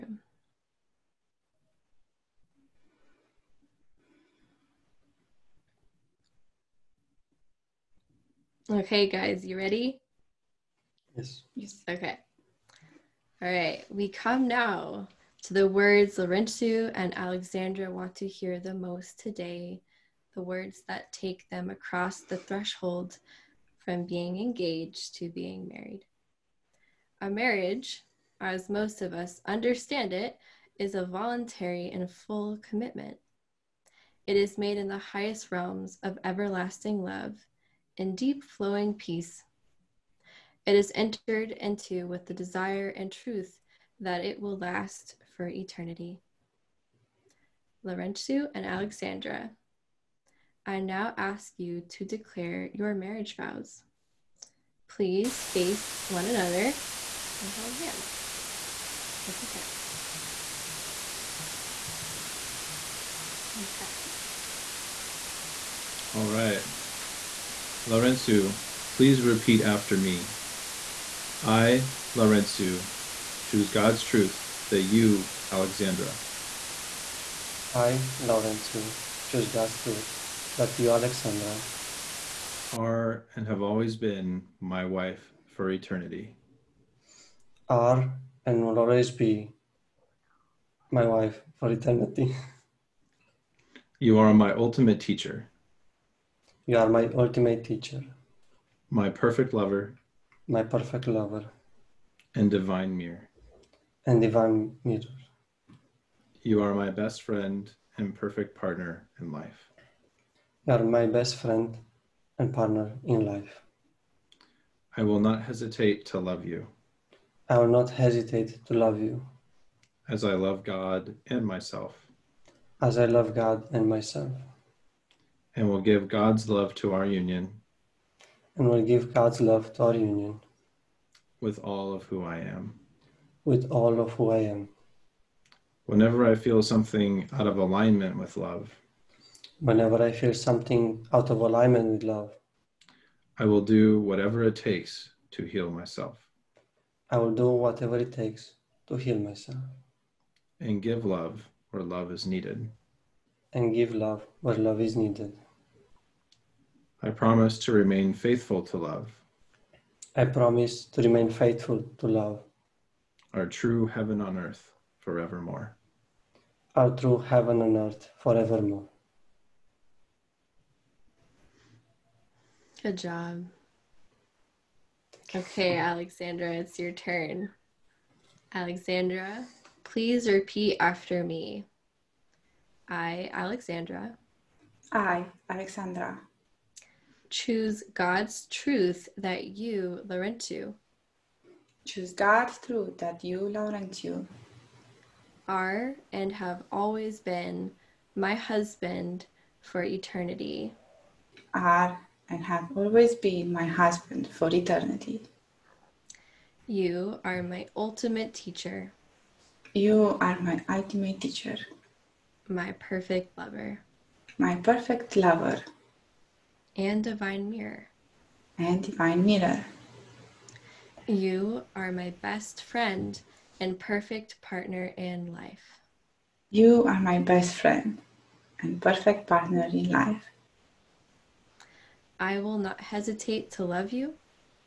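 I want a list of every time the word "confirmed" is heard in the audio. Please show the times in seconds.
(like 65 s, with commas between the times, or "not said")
not said.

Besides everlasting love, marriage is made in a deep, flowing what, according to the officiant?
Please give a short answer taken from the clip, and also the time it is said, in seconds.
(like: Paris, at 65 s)
peace, at 38 s.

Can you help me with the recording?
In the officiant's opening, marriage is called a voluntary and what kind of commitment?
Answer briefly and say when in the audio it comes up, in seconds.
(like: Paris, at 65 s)
full, at 32 s.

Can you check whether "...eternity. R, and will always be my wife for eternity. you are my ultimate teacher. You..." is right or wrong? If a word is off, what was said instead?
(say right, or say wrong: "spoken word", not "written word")
right.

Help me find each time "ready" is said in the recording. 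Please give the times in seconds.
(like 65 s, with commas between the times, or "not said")
9 s.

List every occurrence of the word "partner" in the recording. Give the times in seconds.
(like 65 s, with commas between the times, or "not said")
108 s, 112 s, 224 s, 229 s.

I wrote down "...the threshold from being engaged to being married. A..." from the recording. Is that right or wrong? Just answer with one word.
right.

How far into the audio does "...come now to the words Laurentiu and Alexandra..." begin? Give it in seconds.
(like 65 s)
14 s.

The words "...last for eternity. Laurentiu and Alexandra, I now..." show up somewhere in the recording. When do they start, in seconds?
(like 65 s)
44 s.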